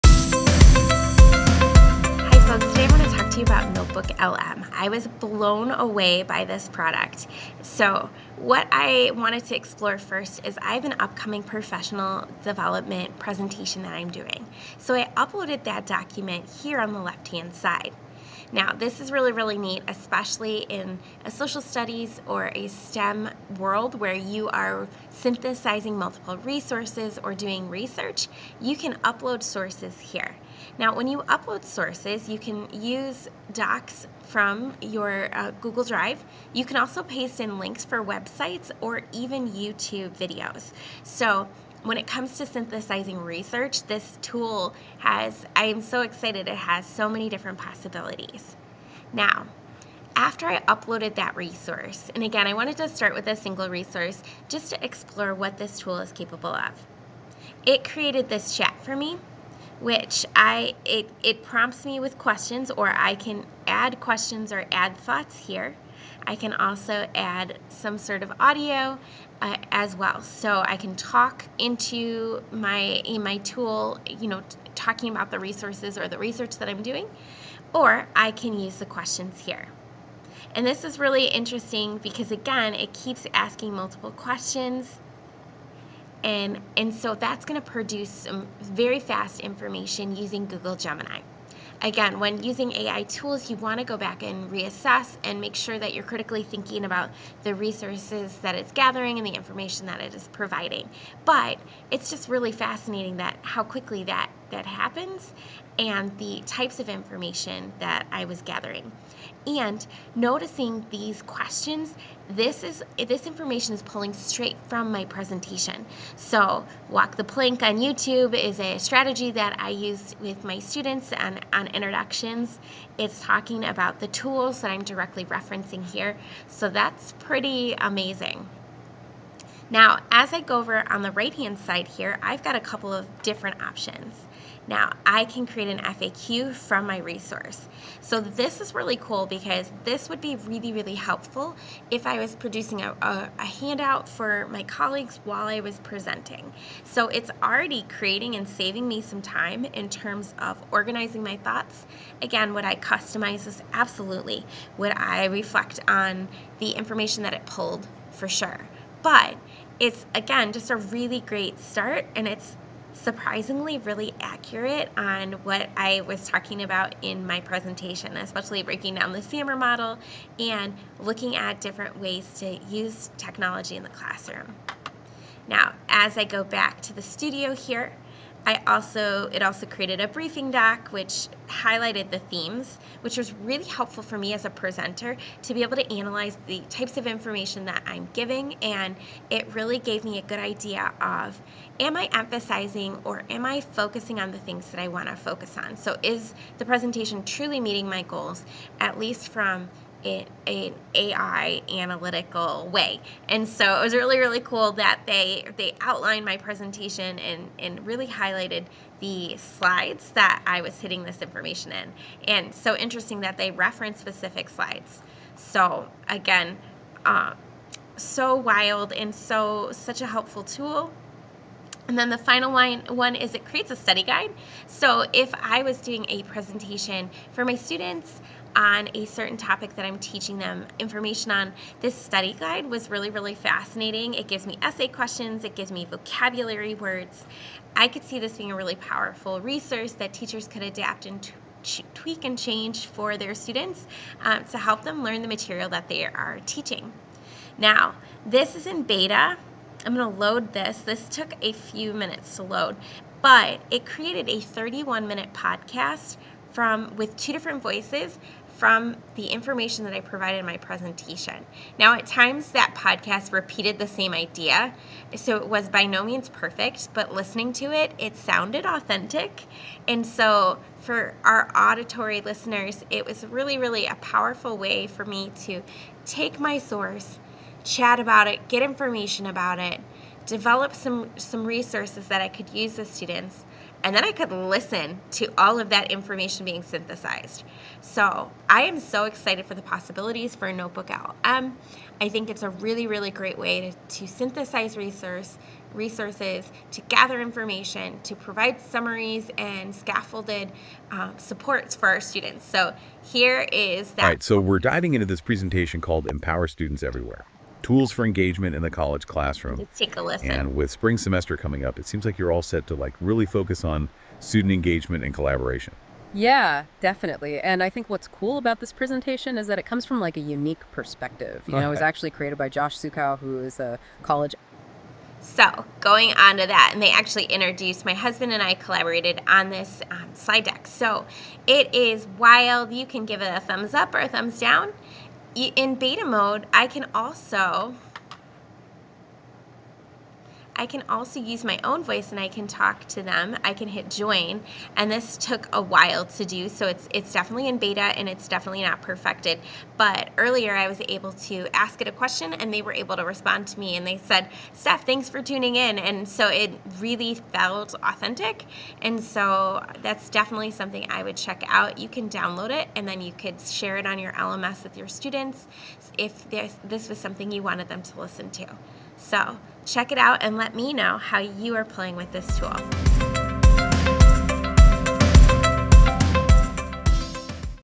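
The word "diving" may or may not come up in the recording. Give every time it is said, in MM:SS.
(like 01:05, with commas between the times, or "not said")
05:04.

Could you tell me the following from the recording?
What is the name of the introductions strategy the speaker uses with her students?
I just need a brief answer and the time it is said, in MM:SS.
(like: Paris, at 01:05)
walk the plank, at 01:56.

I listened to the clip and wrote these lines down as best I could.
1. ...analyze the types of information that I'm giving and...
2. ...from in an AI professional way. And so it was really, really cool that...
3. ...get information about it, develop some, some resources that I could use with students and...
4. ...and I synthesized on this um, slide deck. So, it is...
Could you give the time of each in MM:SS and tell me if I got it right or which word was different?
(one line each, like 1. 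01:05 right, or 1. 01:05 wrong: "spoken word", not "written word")
1. 03:05 right
2. 03:19 wrong: "analytical", not "professional"
3. 04:38 right
4. 05:28 wrong: "collaborated", not "synthesized".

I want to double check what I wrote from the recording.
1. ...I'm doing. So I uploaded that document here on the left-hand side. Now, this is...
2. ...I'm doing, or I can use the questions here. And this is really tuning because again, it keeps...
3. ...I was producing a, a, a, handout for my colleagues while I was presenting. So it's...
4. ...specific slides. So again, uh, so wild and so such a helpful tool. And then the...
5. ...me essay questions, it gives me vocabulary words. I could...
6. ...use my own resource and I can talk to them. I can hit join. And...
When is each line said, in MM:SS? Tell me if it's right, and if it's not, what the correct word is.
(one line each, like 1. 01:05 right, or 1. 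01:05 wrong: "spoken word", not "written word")
1. 00:13 right
2. 01:16 wrong: "interesting", not "tuning"
3. 02:22 right
4. 03:33 right
5. 03:54 right
6. 05:41 wrong: "voice", not "resource".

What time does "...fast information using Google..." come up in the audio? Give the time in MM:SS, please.
01:28.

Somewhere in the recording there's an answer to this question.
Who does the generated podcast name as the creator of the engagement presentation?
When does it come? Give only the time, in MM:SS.
05:22.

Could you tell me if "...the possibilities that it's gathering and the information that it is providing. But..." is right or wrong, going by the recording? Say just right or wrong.
wrong.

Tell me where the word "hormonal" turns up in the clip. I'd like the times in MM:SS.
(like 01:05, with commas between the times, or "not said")
not said.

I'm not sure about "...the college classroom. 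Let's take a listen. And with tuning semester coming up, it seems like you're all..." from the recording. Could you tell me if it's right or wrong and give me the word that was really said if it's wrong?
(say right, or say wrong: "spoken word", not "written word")
wrong: "spring", not "tuning".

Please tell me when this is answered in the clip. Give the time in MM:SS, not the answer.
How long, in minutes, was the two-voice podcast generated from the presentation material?
04:14.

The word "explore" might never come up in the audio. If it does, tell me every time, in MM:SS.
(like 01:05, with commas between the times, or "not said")
00:09, 00:54.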